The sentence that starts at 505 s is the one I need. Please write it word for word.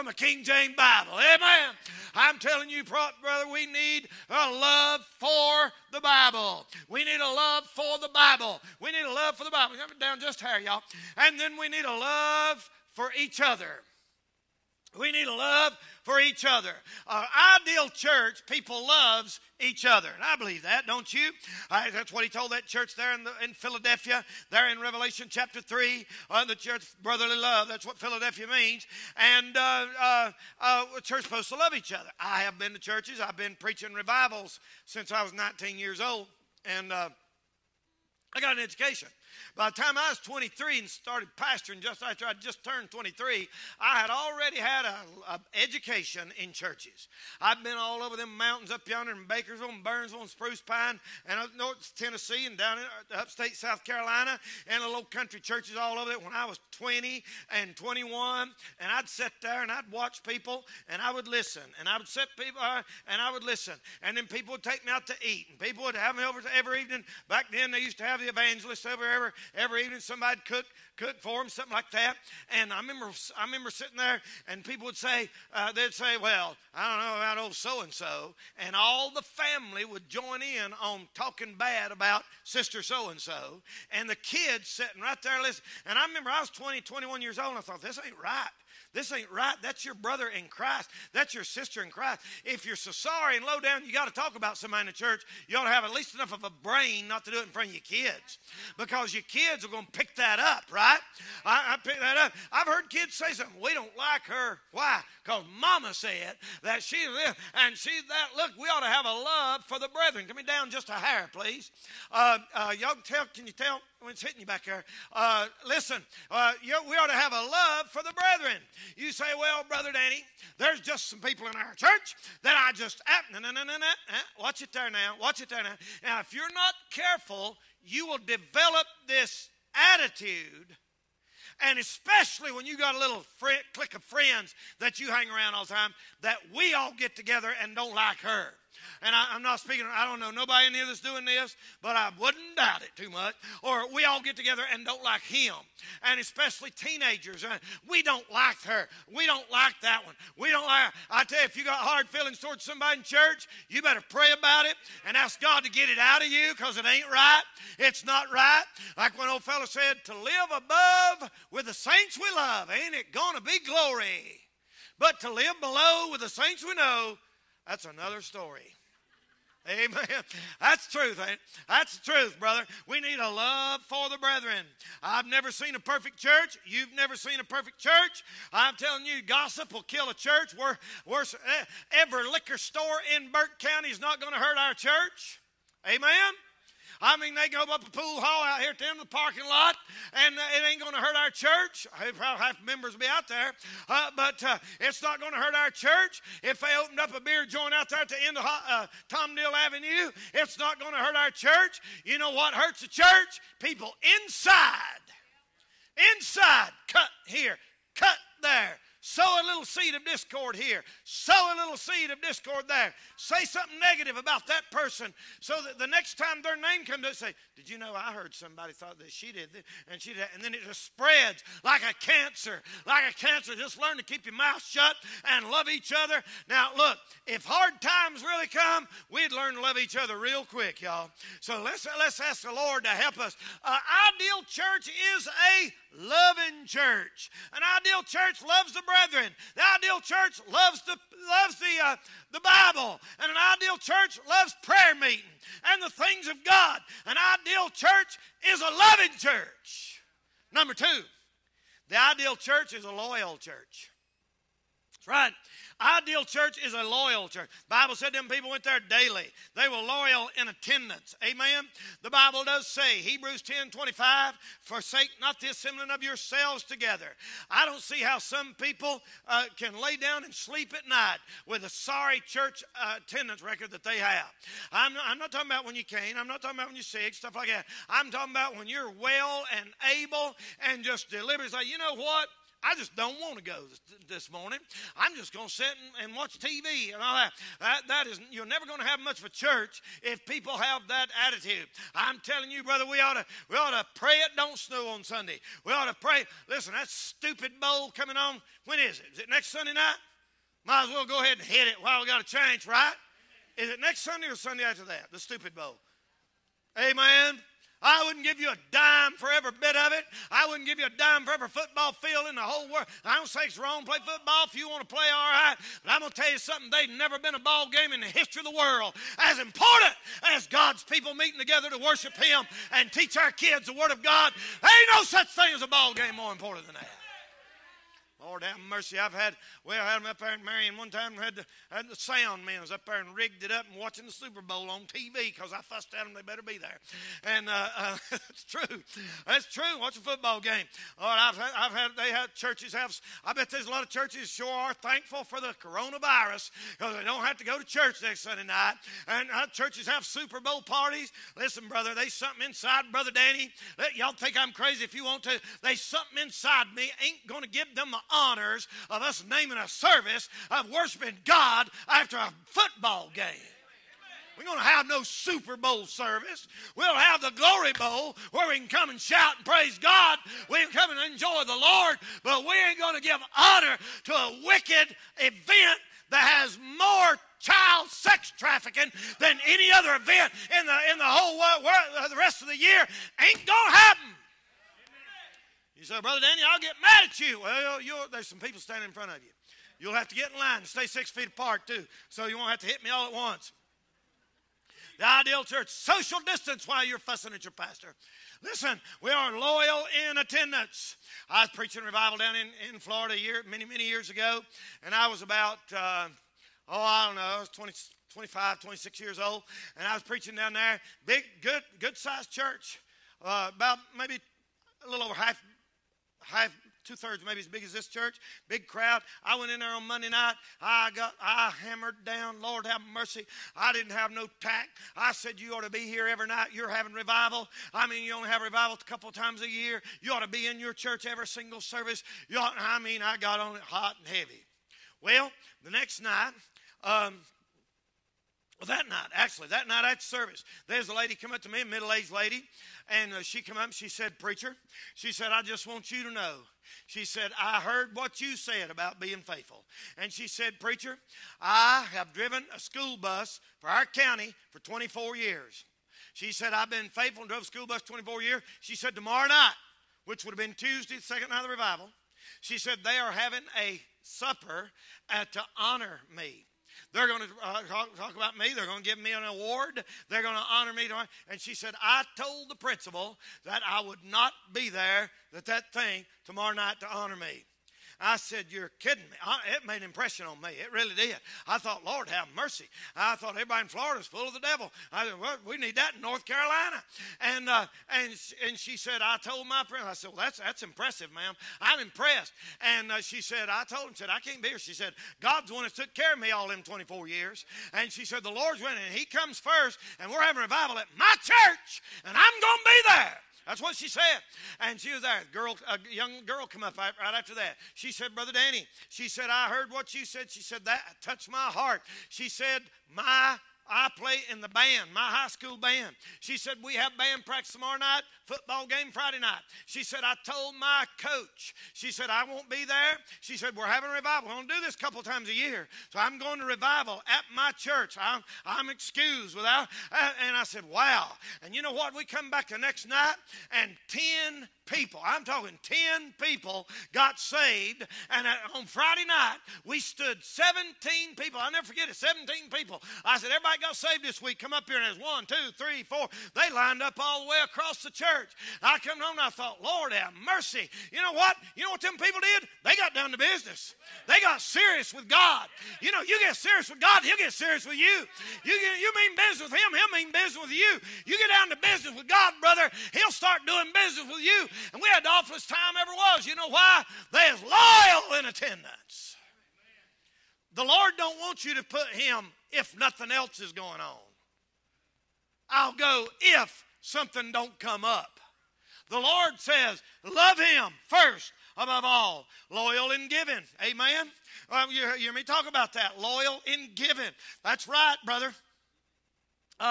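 A, girl, a young girl come up right after that.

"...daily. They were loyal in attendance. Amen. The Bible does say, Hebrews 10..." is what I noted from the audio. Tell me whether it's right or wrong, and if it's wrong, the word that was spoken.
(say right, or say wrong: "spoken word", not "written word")
right.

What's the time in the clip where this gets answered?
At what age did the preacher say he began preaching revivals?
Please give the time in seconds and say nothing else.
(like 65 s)
35 s.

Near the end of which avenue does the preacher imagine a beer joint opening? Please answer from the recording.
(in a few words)
Tom Neal Avenue.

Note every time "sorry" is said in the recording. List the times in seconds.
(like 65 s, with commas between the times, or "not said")
92 s, 271 s.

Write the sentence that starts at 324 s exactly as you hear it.
There ain't no such thing as a ball game more important than that.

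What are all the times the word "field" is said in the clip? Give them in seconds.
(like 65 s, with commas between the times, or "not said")
311 s.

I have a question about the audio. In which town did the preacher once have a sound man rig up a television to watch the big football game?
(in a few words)
Marion.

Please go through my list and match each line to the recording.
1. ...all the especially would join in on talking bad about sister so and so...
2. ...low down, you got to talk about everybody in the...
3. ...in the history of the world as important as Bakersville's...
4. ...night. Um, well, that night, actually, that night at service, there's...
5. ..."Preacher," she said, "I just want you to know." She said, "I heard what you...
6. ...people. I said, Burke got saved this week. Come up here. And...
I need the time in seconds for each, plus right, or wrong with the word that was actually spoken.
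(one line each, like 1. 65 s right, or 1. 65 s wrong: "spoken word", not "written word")
1. 78 s wrong: "family", not "especially"
2. 93 s wrong: "somebody", not "everybody"
3. 317 s wrong: "God", not "Bakersville"
4. 436 s right
5. 444 s right
6. 542 s wrong: "Everybody", not "Burke".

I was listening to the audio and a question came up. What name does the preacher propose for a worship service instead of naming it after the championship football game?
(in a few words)
Glory Bowl.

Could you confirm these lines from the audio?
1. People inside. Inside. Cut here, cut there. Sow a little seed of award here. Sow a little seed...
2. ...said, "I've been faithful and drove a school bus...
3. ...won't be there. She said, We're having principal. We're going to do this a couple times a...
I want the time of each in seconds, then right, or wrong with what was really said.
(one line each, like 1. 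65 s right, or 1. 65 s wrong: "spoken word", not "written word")
1. 203 s wrong: "discord", not "award"
2. 456 s right
3. 522 s wrong: "revival", not "principal".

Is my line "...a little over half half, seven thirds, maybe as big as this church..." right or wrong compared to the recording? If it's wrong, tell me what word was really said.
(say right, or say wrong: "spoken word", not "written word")
wrong: "two", not "seven".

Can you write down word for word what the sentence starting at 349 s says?
And uh, churches have Super Bowl parties.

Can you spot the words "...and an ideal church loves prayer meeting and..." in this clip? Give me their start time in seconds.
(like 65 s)
243 s.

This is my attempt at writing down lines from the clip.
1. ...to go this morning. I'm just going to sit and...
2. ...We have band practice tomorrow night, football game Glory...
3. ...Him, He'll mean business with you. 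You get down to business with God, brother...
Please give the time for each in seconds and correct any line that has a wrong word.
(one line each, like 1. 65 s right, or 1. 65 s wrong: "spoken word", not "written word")
1. 283 s right
2. 516 s wrong: "Friday", not "Glory"
3. 559 s right.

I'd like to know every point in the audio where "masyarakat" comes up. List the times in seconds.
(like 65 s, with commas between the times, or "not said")
not said.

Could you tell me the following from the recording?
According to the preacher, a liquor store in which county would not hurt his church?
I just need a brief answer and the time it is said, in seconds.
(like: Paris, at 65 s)
Burke County, at 183 s.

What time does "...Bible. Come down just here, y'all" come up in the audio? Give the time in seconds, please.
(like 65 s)
9 s.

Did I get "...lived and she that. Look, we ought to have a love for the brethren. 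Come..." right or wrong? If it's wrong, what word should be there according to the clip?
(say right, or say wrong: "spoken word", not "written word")
right.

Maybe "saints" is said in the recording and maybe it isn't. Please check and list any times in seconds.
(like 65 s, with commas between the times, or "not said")
161 s, 166 s.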